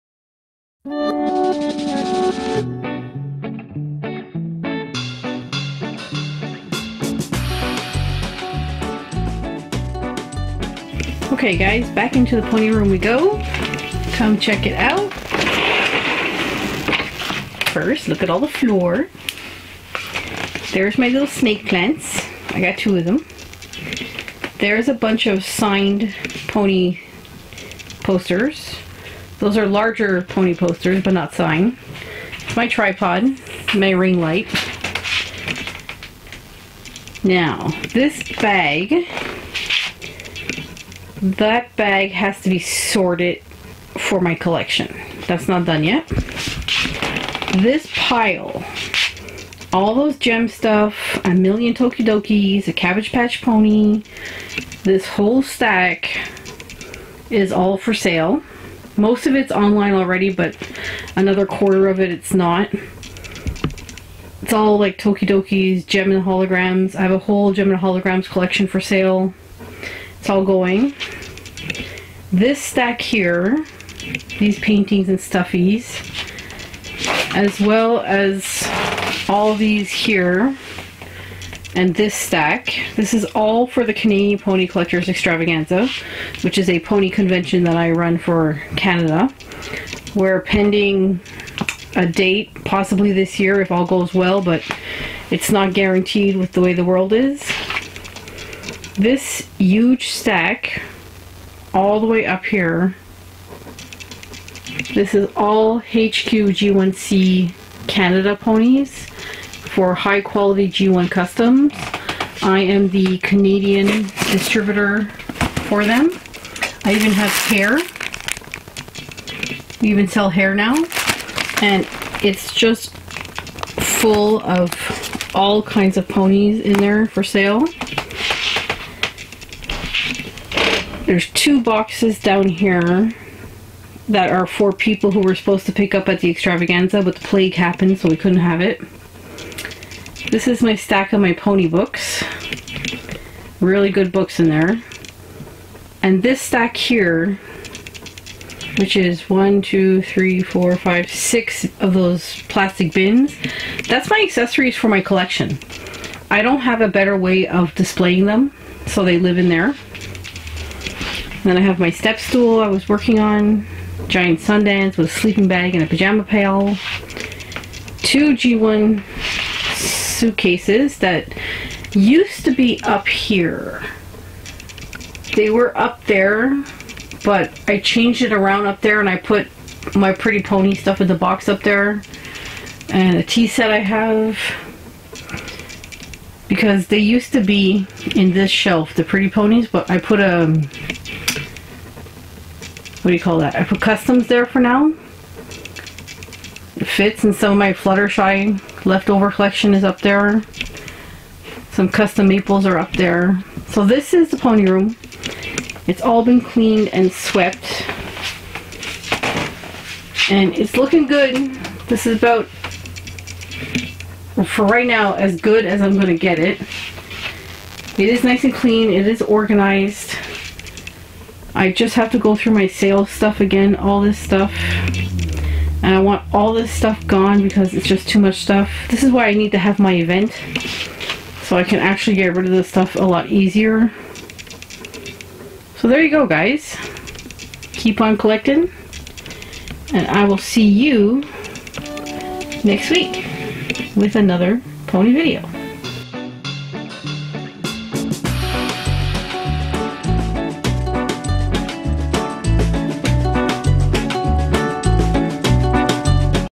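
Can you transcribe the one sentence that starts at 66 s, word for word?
I have a whole Jem and holograms collection for sale.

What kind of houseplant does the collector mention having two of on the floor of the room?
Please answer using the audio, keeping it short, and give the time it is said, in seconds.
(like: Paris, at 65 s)
snake plants, at 21 s.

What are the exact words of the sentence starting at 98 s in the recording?
This huge stack, all the way up here, this is all HQ G1C Canada ponies for high quality G1 Customs.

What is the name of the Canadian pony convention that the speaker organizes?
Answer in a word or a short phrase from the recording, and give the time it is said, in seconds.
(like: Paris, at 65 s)
Canadian Pony Collectors Extravaganza, at 83 s.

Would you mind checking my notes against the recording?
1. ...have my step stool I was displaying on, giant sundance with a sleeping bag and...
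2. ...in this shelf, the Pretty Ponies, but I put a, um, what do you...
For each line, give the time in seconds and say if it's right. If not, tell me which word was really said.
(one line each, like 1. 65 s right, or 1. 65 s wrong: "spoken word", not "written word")
1. 161 s wrong: "working", not "displaying"
2. 188 s right.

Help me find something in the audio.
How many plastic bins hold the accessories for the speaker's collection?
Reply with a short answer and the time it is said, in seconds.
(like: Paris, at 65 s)
6, at 151 s.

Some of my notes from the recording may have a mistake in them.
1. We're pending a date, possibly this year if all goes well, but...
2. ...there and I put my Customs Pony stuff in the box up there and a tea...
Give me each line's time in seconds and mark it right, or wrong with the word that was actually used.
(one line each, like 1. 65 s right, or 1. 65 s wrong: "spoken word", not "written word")
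1. 90 s right
2. 178 s wrong: "Pretty", not "Customs".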